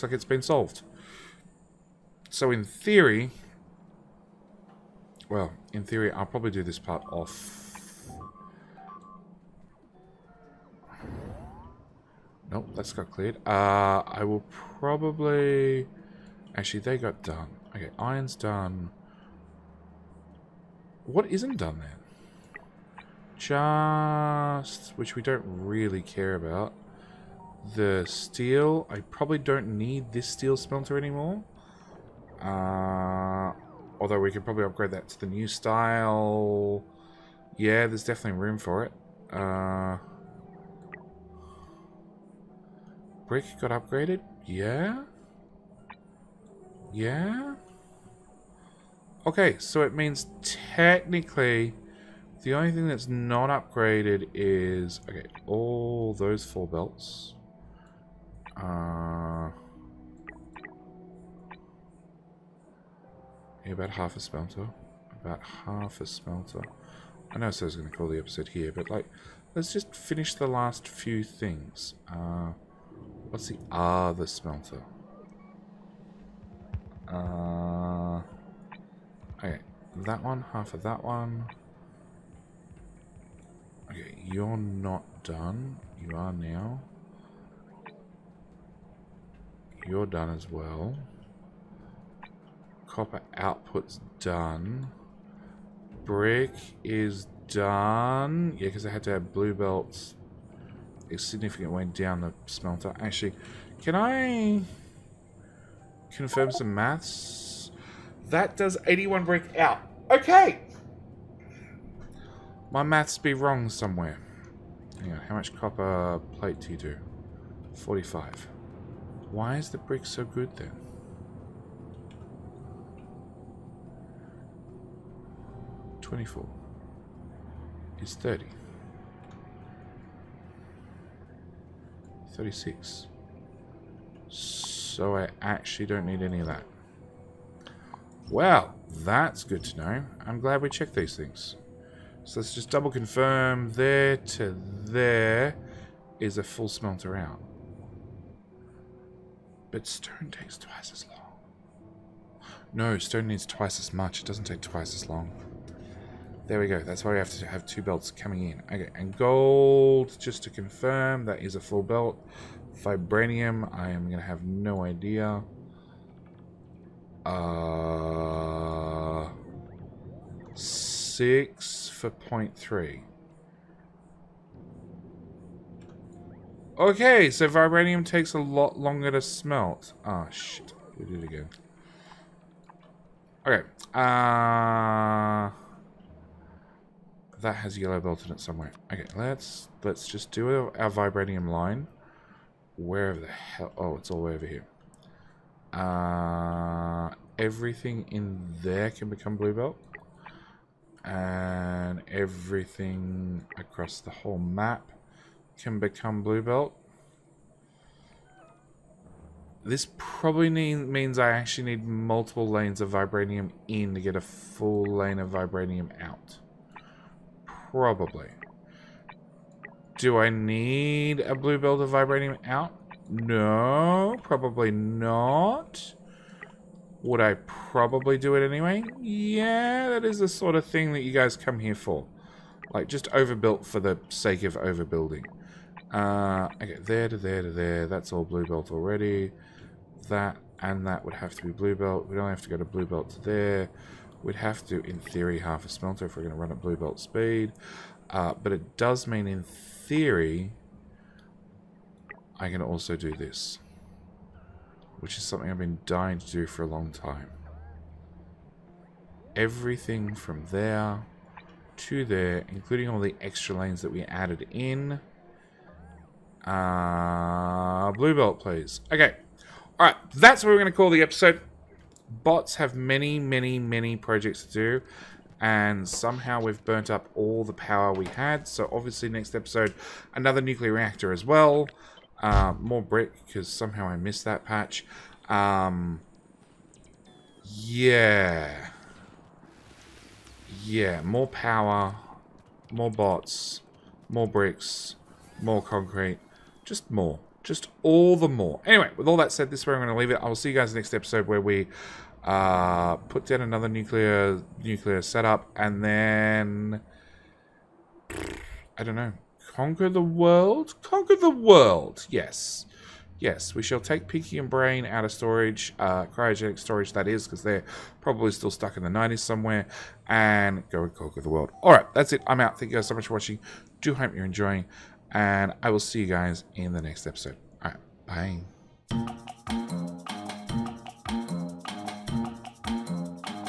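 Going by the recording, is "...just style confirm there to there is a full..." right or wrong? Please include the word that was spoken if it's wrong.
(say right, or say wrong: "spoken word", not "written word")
wrong: "double", not "style".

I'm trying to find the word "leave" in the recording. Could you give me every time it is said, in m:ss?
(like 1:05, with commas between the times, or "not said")
4:59.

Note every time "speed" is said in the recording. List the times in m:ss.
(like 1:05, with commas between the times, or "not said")
4:06.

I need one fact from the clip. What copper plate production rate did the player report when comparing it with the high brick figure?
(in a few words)
45.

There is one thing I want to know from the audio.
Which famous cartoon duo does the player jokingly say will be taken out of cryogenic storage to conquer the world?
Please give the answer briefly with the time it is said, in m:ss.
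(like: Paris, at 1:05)
Pinky and Brain, at 5:14.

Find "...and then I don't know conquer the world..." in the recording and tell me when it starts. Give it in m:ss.
5:05.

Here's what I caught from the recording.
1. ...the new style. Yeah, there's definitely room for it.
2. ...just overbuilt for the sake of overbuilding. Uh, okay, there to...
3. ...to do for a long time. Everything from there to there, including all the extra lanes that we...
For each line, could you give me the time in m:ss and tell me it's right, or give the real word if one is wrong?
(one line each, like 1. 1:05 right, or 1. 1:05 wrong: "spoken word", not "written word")
1. 0:35 right
2. 3:52 right
3. 4:16 right.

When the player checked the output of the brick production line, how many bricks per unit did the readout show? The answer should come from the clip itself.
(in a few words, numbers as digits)
81.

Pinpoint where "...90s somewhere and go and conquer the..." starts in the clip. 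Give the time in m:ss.
5:18.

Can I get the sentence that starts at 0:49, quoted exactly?
Okay, so it means technically the only thing that's not upgraded is...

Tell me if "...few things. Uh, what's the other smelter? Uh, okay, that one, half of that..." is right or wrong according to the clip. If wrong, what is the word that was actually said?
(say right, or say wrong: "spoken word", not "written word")
right.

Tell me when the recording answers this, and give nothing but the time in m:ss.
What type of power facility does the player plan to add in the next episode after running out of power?
4:40.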